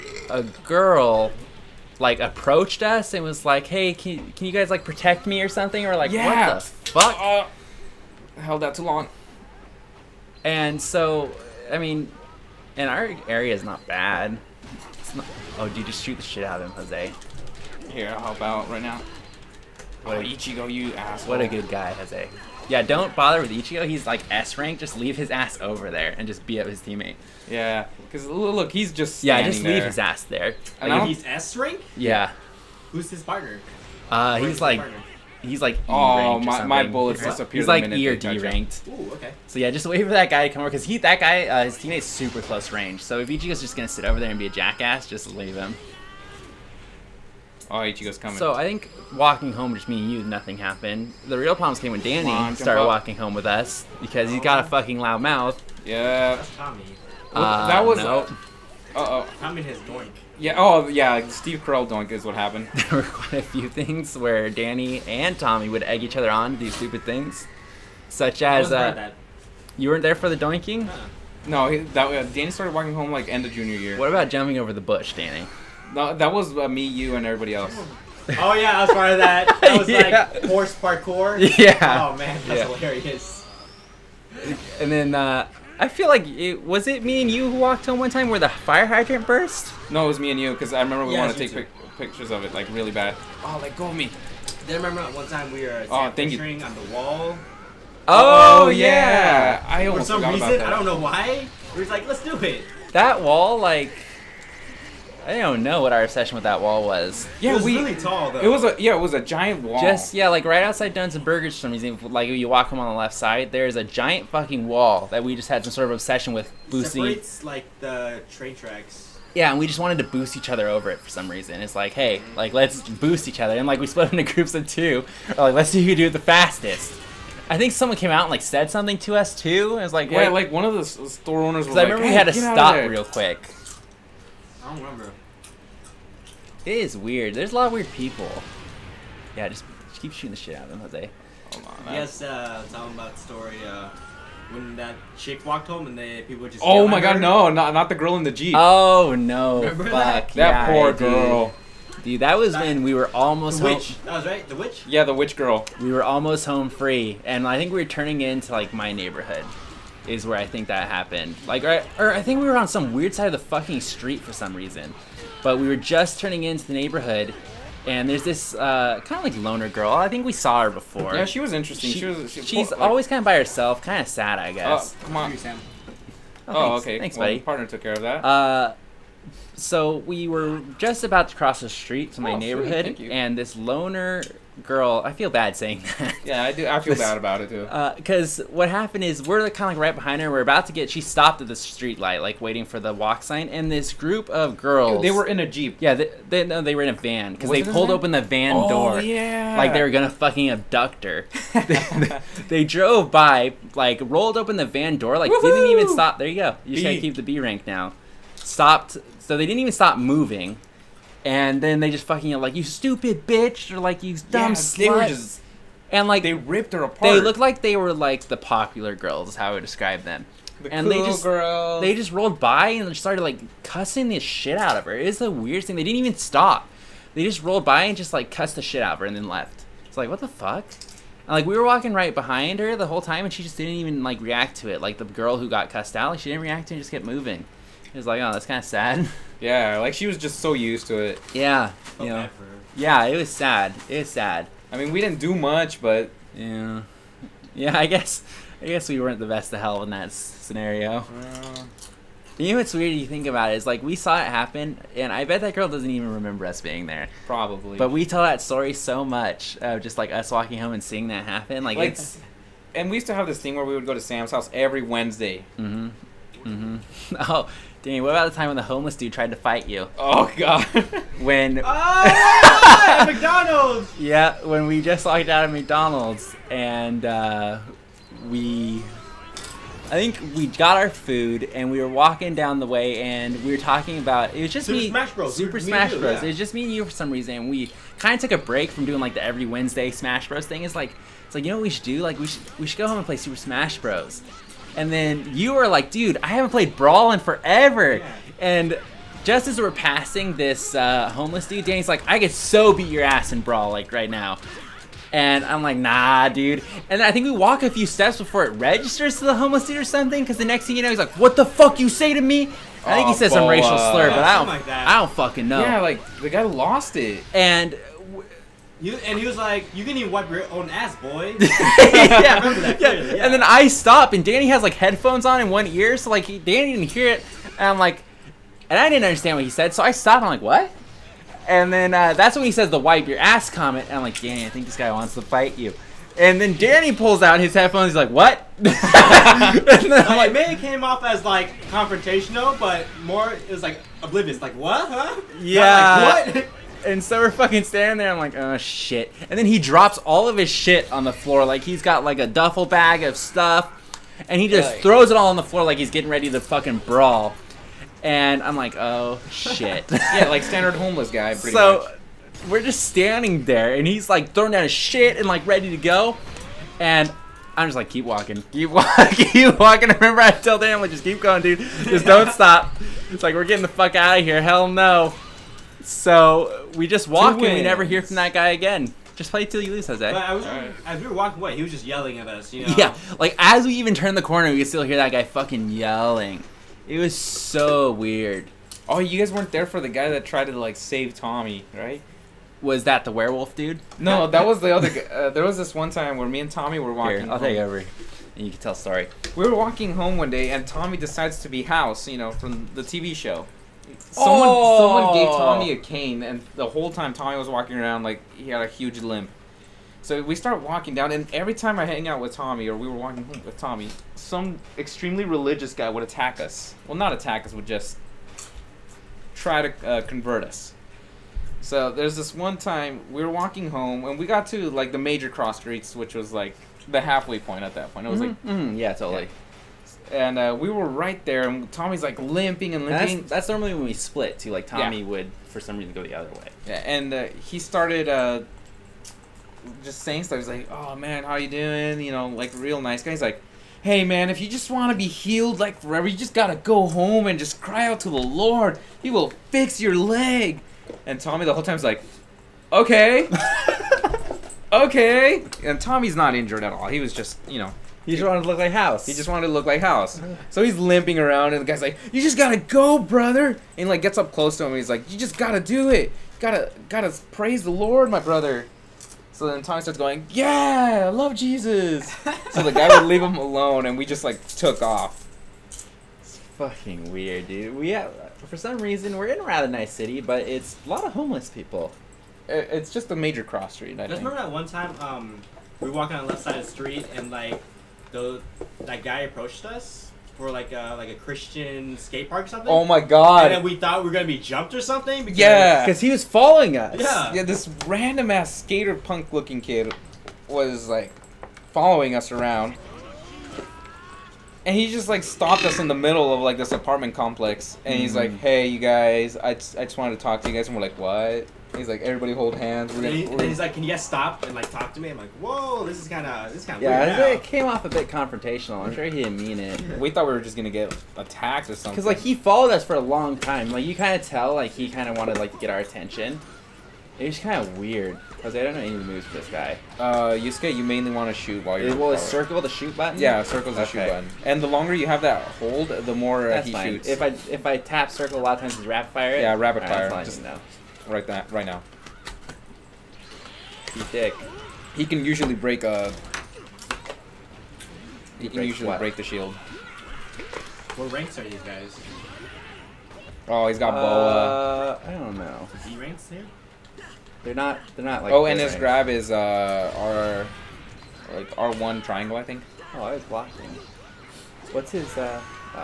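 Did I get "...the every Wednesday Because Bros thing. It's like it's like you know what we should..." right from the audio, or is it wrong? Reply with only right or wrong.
wrong.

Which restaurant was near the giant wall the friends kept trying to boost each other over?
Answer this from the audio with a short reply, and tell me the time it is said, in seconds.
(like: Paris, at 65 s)
Duns and Burgers, at 110 s.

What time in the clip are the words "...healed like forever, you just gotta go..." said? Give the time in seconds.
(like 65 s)
445 s.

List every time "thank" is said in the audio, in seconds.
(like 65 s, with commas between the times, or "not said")
96 s, 176 s.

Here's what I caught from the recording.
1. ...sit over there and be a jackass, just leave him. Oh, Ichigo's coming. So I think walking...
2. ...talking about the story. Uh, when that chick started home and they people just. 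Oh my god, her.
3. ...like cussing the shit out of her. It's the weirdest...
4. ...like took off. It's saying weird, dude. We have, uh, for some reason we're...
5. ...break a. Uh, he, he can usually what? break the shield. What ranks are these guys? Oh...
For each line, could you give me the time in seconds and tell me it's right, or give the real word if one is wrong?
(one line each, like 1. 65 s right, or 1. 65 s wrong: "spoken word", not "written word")
1. 43 s right
2. 142 s wrong: "walked", not "started"
3. 223 s right
4. 474 s wrong: "fucking", not "saying"
5. 545 s right.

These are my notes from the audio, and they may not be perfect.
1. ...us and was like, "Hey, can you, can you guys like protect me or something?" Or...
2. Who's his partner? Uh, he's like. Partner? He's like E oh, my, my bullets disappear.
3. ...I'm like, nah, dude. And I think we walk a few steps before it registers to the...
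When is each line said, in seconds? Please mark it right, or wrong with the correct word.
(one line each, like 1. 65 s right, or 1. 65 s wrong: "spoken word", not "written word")
1. 2 s right
2. 32 s right
3. 305 s right.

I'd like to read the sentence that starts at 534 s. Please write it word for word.
And the longer you have that hold, the more uh, he fine.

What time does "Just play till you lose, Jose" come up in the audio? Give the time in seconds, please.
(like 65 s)
379 s.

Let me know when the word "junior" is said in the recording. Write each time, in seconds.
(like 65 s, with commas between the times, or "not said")
73 s.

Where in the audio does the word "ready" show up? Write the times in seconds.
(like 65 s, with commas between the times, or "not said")
356 s, 365 s.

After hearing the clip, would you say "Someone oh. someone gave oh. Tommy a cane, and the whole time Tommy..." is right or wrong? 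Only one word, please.
right.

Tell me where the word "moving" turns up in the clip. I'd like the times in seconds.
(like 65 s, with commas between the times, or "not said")
209 s, 237 s.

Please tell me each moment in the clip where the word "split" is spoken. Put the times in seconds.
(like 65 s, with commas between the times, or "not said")
123 s, 433 s.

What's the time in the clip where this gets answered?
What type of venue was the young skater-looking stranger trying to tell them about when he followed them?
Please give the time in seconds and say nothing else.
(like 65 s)
491 s.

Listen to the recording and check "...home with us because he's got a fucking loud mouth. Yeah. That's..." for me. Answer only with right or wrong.
right.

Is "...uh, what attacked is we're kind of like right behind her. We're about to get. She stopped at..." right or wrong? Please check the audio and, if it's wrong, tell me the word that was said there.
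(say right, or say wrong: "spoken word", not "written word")
wrong: "happened", not "attacked".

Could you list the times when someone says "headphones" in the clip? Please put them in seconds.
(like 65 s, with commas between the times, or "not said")
324 s, 337 s.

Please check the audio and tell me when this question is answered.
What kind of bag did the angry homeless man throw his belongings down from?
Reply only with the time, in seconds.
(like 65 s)
352 s.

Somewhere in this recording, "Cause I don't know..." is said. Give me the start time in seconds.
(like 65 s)
528 s.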